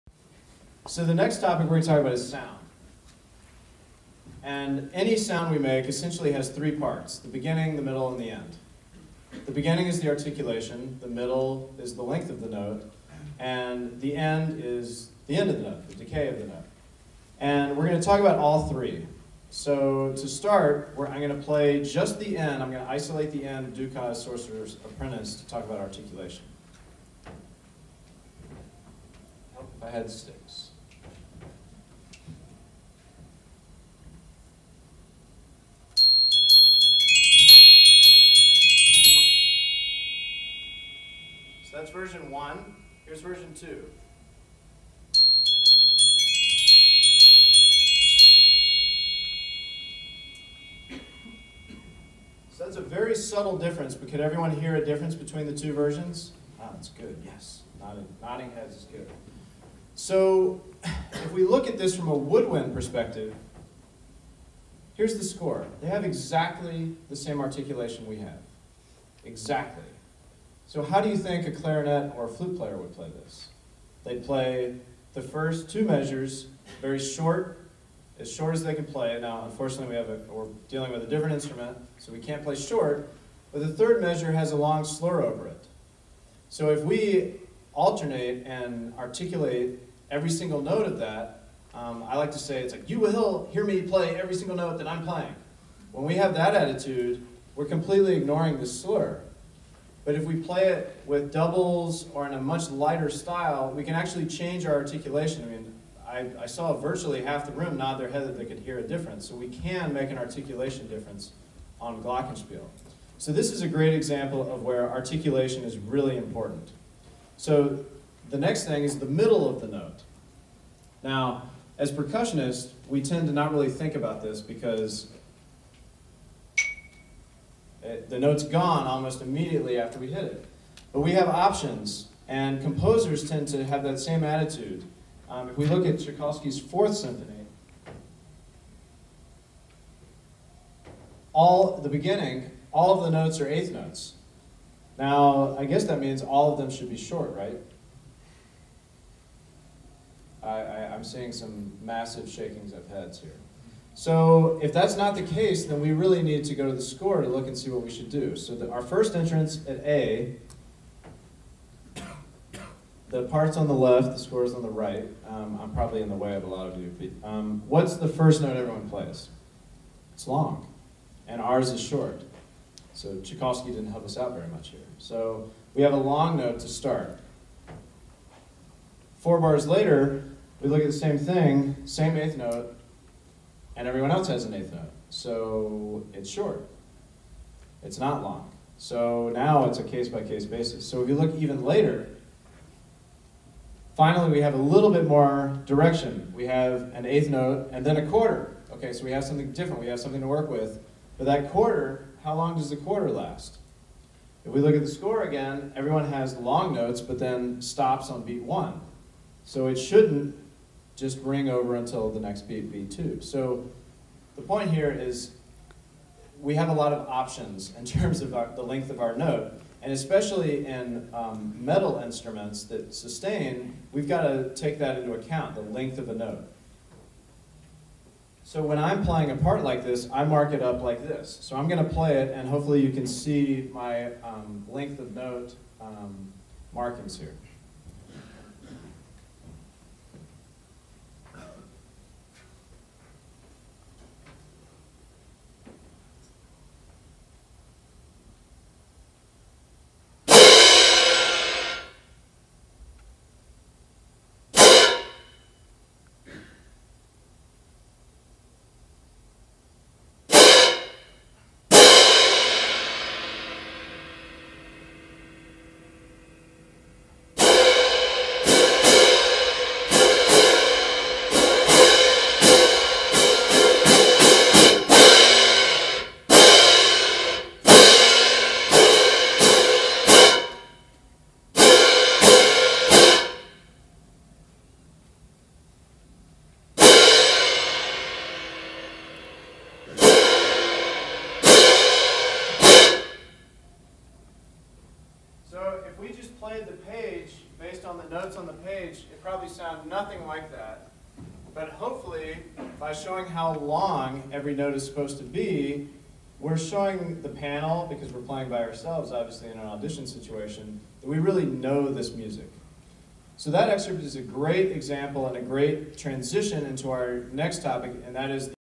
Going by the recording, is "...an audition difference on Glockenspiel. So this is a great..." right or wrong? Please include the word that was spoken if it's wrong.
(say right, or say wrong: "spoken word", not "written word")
wrong: "articulation", not "audition".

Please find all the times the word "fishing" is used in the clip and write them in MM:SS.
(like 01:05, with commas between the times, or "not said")
not said.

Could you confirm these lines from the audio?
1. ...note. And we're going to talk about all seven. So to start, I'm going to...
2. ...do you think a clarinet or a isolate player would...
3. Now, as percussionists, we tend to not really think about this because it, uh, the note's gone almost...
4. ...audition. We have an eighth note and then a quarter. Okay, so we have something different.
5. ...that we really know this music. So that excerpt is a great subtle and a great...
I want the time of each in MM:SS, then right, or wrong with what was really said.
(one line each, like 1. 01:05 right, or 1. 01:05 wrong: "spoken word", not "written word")
1. 00:16 wrong: "three", not "seven"
2. 01:11 wrong: "flute", not "isolate"
3. 02:01 right
4. 03:15 wrong: "direction", not "audition"
5. 05:11 wrong: "example", not "subtle".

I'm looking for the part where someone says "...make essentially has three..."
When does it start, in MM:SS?
00:05.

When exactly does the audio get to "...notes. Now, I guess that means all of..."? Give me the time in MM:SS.
02:23.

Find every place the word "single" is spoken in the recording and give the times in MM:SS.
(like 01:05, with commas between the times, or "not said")
01:30, 01:34.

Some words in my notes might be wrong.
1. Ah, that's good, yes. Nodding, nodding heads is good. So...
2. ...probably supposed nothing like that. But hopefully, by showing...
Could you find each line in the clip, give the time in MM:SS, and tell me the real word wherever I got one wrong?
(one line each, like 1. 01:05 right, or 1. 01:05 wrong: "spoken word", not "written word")
1. 00:56 right
2. 04:59 wrong: "sounded", not "supposed".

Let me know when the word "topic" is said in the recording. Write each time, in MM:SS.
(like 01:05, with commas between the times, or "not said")
00:01, 05:17.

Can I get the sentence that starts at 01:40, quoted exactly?
But if we play it with doubles or in a much lighter style, we can actually change our articulation.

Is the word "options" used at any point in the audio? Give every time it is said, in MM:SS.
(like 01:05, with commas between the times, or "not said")
02:11, 03:37.